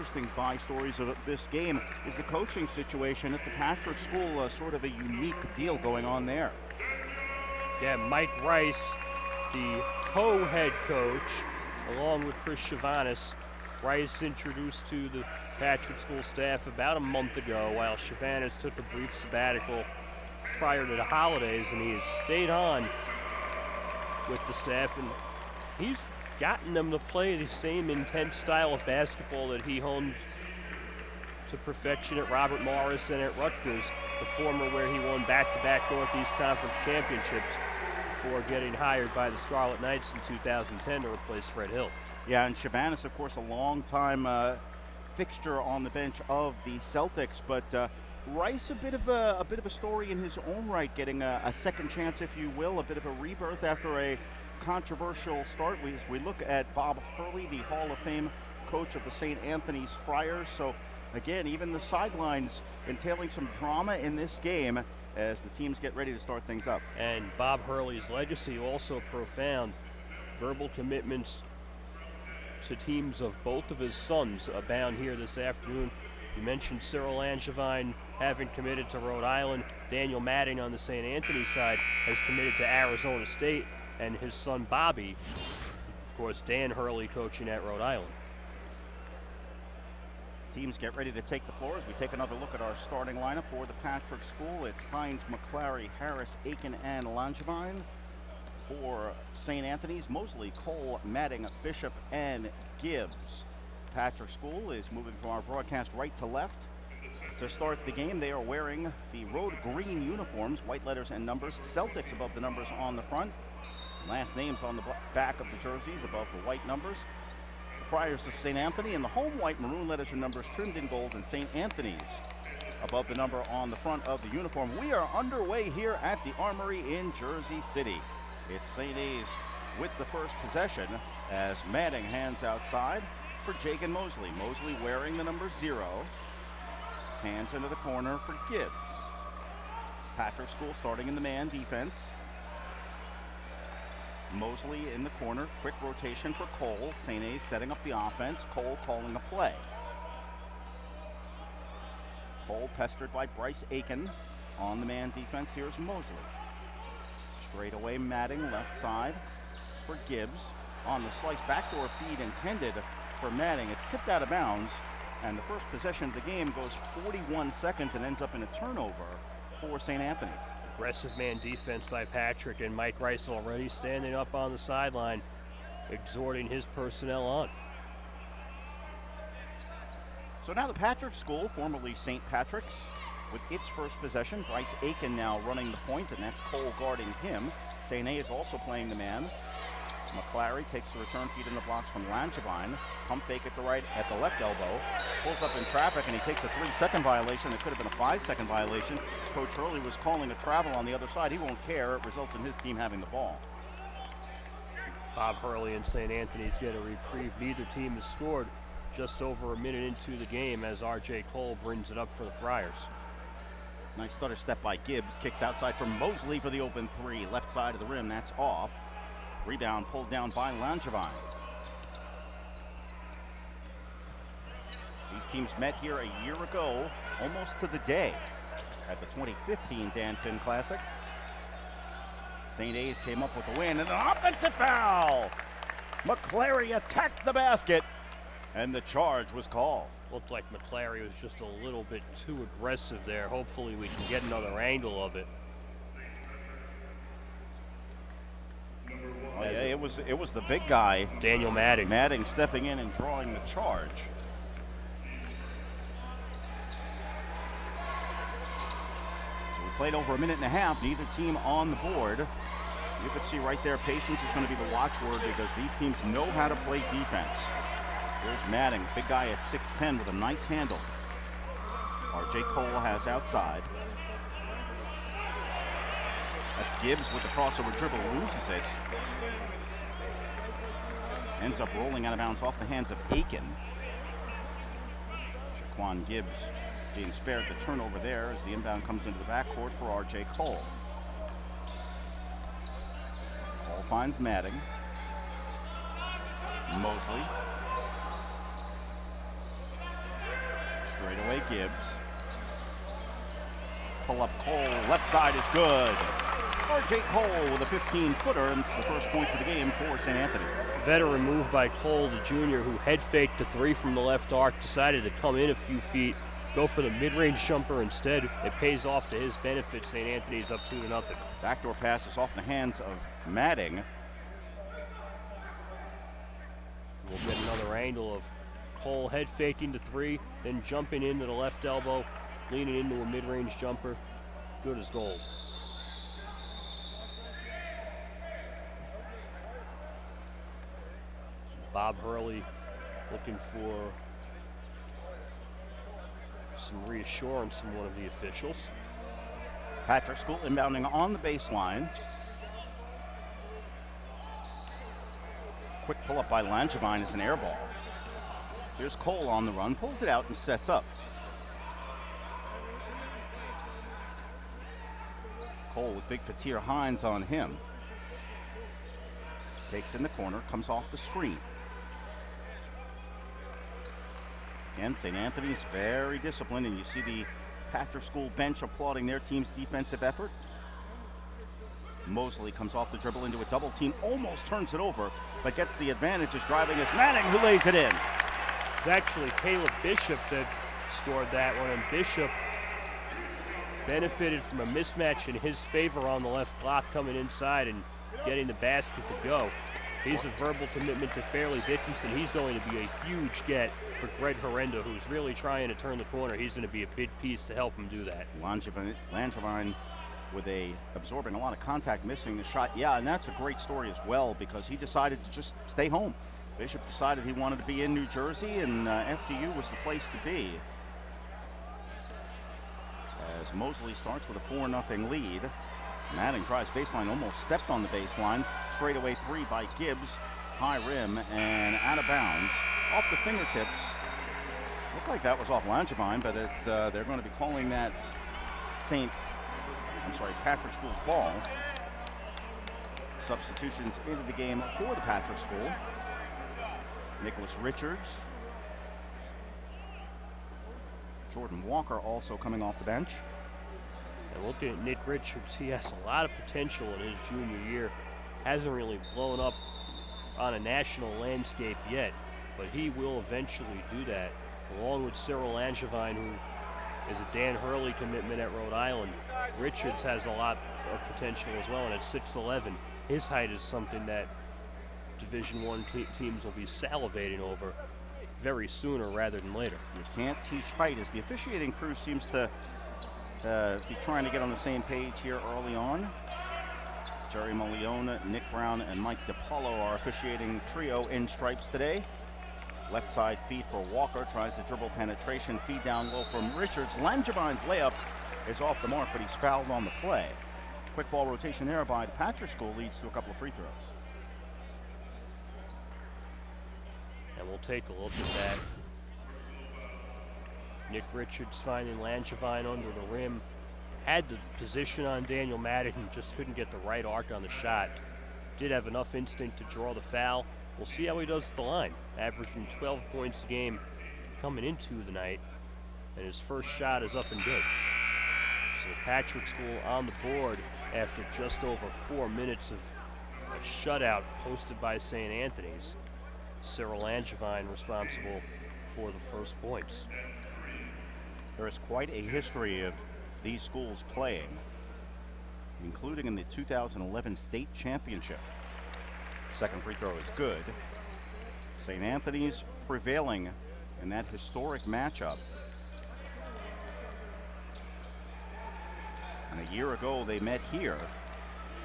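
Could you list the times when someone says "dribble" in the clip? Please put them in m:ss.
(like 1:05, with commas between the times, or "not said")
4:37, 6:22, 8:14.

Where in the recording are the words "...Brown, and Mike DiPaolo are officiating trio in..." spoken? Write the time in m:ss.
8:08.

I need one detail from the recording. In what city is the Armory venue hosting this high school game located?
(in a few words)
Jersey City.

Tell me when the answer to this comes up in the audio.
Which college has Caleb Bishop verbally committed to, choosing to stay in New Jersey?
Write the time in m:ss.
6:41.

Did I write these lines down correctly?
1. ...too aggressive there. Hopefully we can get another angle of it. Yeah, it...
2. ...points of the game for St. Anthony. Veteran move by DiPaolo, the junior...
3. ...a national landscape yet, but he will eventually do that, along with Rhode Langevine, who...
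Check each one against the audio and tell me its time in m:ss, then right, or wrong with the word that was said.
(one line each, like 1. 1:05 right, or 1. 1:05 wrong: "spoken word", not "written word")
1. 4:02 right
2. 5:09 wrong: "Cole", not "DiPaolo"
3. 7:40 wrong: "Cyril", not "Rhode".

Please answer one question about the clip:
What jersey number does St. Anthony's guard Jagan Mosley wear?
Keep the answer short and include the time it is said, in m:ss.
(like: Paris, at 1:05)
0, at 2:15.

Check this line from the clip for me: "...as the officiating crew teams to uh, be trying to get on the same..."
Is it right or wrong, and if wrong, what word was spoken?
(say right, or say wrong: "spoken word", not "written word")
wrong: "seems", not "teams".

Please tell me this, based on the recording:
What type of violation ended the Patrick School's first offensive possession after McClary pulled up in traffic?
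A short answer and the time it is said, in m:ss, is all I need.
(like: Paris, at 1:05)
Three-second violation, at 3:16.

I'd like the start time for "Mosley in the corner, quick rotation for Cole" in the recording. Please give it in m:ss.
2:24.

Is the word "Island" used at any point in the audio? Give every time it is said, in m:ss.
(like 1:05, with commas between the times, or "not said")
1:19, 1:27, 7:48.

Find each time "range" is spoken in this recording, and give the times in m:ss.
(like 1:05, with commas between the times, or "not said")
5:16, 5:33.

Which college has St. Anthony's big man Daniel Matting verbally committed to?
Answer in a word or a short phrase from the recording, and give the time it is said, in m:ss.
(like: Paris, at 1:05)
Arizona State, at 1:22.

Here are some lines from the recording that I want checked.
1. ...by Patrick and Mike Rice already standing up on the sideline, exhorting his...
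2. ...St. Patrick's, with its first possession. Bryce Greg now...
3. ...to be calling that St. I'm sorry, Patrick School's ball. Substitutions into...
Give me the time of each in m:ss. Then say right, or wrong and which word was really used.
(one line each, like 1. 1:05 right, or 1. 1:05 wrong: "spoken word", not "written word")
1. 2:51 right
2. 3:01 wrong: "Aiken", not "Greg"
3. 7:17 right.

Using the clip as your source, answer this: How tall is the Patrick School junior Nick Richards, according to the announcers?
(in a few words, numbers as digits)
6'11.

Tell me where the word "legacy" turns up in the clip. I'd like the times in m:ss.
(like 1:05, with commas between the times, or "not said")
1:08.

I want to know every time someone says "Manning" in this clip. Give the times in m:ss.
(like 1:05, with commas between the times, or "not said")
2:11, 2:43, 6:26.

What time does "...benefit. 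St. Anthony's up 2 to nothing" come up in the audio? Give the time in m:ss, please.
5:19.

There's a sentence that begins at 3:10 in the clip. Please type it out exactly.
McClary takes the return feed in the blocks from Langevine.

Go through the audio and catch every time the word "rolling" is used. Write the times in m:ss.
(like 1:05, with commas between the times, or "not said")
4:41.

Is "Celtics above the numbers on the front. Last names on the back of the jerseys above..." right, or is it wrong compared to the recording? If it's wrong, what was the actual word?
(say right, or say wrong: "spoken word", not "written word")
right.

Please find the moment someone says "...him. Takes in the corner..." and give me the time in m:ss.
6:07.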